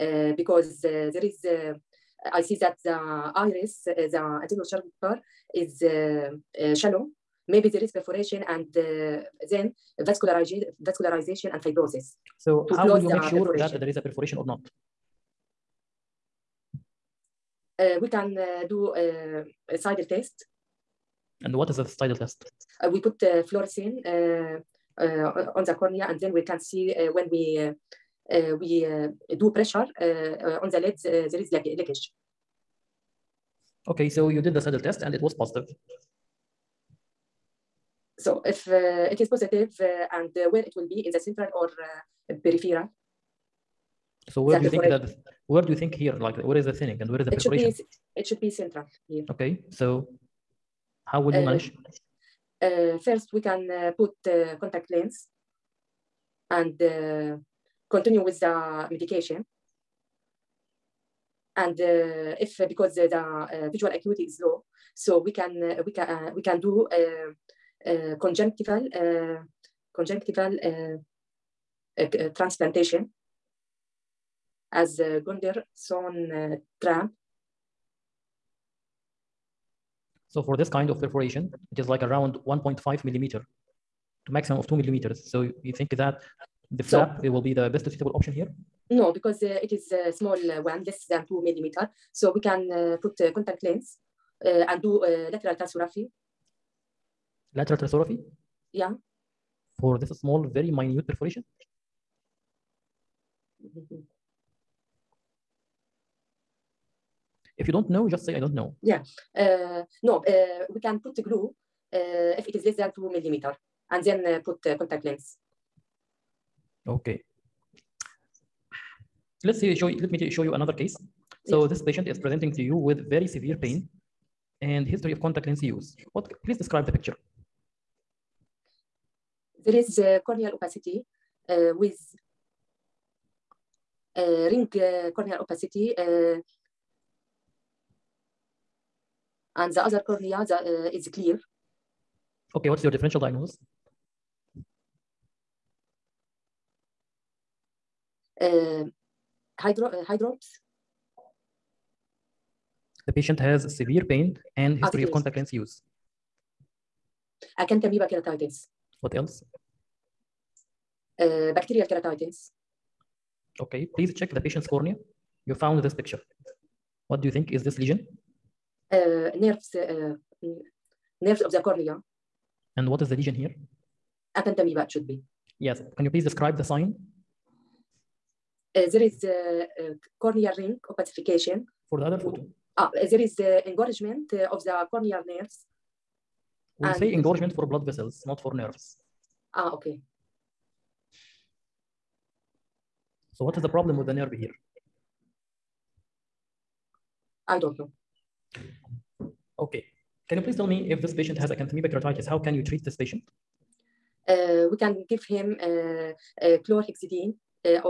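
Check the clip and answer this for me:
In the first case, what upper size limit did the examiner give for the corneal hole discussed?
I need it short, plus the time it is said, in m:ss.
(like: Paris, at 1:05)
2 millimeters, at 1:24.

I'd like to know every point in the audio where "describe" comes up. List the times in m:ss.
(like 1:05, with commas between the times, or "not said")
2:06, 2:56.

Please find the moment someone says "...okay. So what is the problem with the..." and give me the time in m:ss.
3:09.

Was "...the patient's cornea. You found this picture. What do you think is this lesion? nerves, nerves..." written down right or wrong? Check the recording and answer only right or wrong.
right.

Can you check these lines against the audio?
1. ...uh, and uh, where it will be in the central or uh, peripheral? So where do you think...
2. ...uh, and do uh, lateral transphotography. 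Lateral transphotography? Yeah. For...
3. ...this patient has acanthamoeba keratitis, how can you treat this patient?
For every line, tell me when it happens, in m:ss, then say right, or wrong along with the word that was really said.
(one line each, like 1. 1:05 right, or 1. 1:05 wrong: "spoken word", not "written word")
1. 0:39 right
2. 1:34 right
3. 3:21 right.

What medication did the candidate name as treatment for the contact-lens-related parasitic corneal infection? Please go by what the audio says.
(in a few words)
chlorhexidine.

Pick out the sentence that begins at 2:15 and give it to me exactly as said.
Uh, and the other cornea the, uh, is clear.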